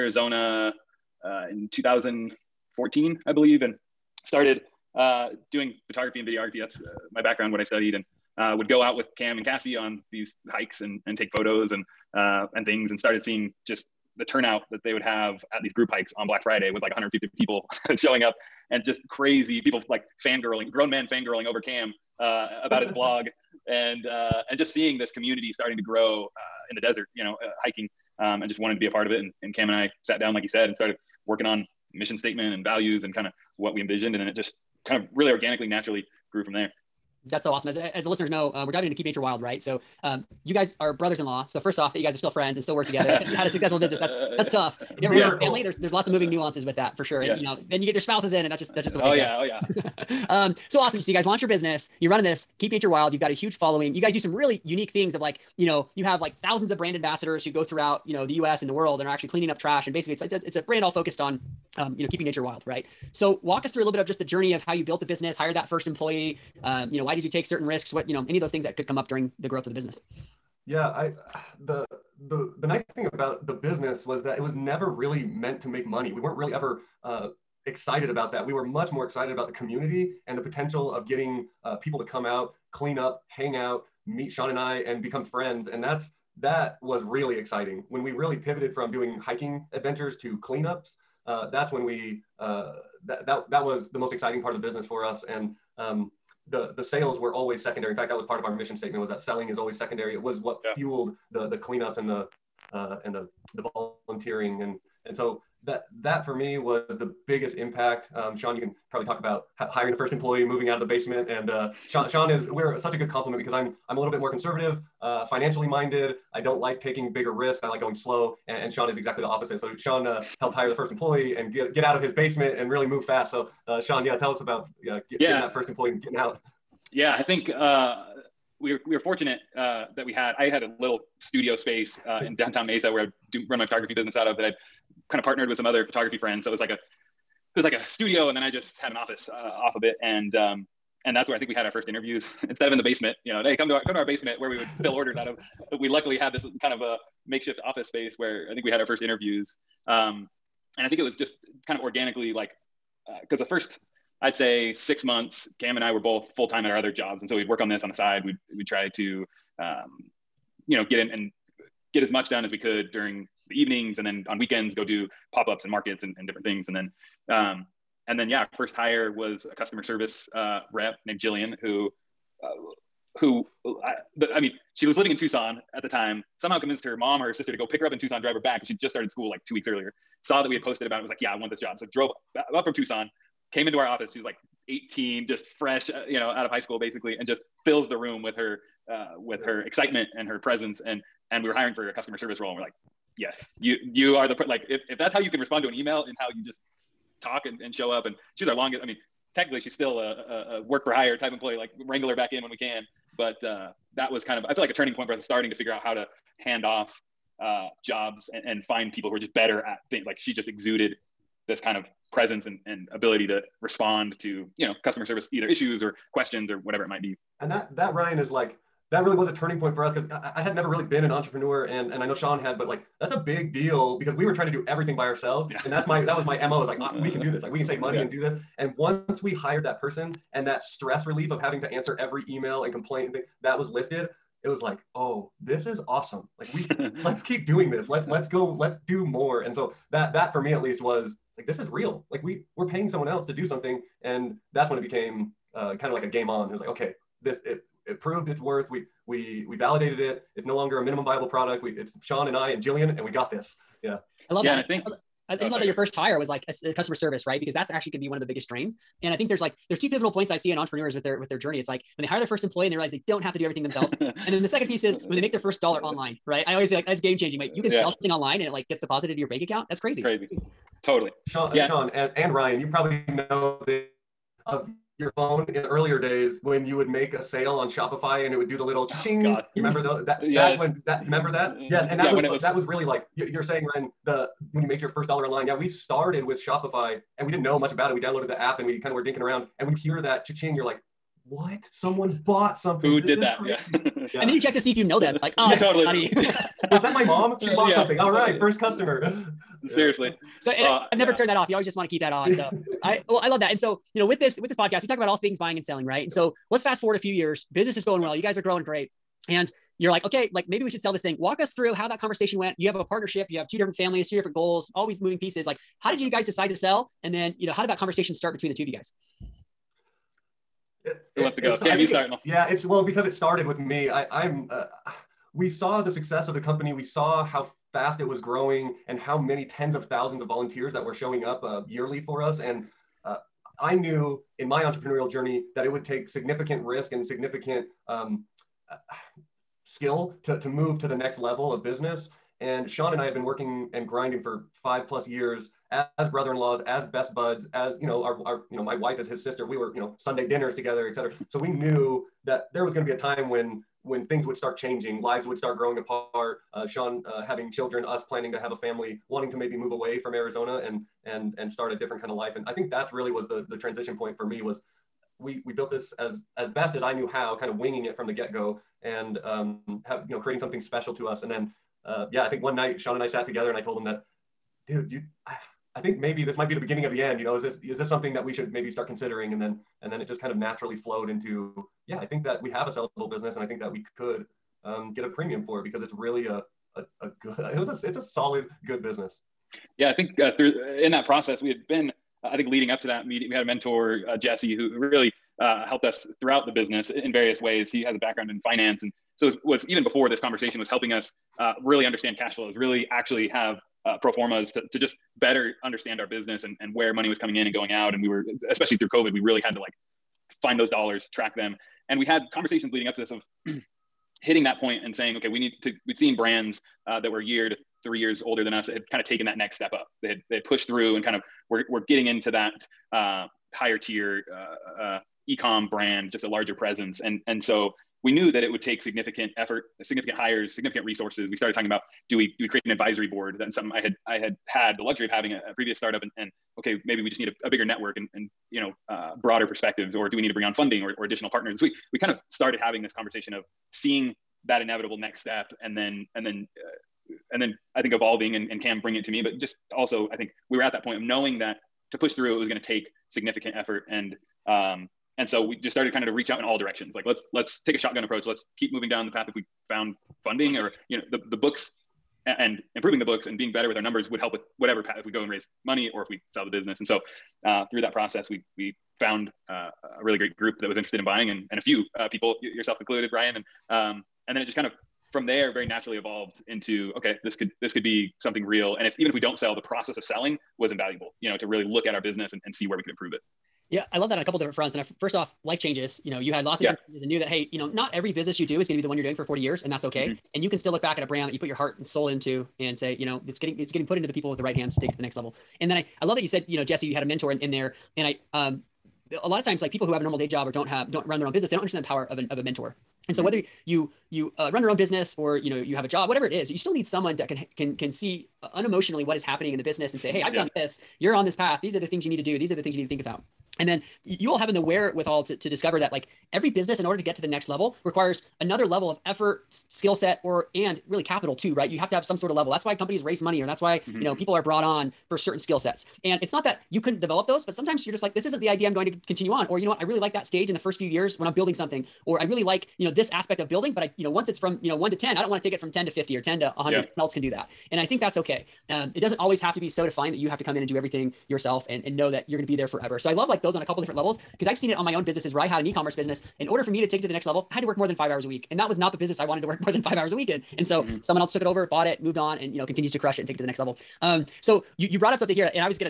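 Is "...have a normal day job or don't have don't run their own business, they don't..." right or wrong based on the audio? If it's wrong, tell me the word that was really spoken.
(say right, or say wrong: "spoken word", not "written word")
right.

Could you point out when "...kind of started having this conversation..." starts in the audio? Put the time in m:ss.
7:21.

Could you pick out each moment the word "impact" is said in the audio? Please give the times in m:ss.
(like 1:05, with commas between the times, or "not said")
1:47.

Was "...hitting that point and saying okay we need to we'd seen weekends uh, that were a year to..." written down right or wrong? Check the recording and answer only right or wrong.
wrong.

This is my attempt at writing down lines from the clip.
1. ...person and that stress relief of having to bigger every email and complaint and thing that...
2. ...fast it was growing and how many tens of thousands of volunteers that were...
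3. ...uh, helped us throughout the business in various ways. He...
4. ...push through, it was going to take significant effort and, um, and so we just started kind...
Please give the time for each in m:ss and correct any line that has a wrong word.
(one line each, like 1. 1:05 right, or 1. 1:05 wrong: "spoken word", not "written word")
1. 3:49 wrong: "answer", not "bigger"
2. 5:27 right
3. 6:35 right
4. 7:31 right.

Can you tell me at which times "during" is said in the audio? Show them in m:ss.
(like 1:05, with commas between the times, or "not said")
1:09, 2:42.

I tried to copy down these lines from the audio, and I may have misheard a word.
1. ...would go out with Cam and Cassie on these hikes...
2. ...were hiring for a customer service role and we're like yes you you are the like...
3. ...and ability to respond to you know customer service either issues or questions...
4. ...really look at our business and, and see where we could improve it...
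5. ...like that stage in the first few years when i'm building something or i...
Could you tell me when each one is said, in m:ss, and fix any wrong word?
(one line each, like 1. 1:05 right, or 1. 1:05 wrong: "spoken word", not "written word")
1. 0:08 right
2. 3:11 right
3. 3:32 right
4. 8:01 right
5. 8:49 right.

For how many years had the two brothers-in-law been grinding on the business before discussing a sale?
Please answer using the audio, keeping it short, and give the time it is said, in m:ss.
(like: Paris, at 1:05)
5, at 5:44.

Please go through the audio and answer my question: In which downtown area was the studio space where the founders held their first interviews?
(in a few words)
Mesa.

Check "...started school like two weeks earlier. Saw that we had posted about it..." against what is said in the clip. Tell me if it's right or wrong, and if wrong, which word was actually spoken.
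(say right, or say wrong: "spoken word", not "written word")
right.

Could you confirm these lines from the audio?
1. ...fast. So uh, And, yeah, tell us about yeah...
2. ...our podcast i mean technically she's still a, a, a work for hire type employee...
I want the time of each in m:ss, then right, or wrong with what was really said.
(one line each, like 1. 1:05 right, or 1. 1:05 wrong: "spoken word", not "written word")
1. 2:03 wrong: "Sean", not "And"
2. 3:18 wrong: "longest", not "podcast".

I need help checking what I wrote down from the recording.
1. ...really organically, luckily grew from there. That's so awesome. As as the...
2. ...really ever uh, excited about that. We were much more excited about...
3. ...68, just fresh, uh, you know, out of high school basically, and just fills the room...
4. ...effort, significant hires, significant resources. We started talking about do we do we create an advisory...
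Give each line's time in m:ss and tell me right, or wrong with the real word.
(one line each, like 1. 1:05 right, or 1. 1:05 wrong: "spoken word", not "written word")
1. 0:35 wrong: "naturally", not "luckily"
2. 1:16 right
3. 3:04 wrong: "18", not "68"
4. 7:09 right.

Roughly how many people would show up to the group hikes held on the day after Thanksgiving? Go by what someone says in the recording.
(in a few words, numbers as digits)
150.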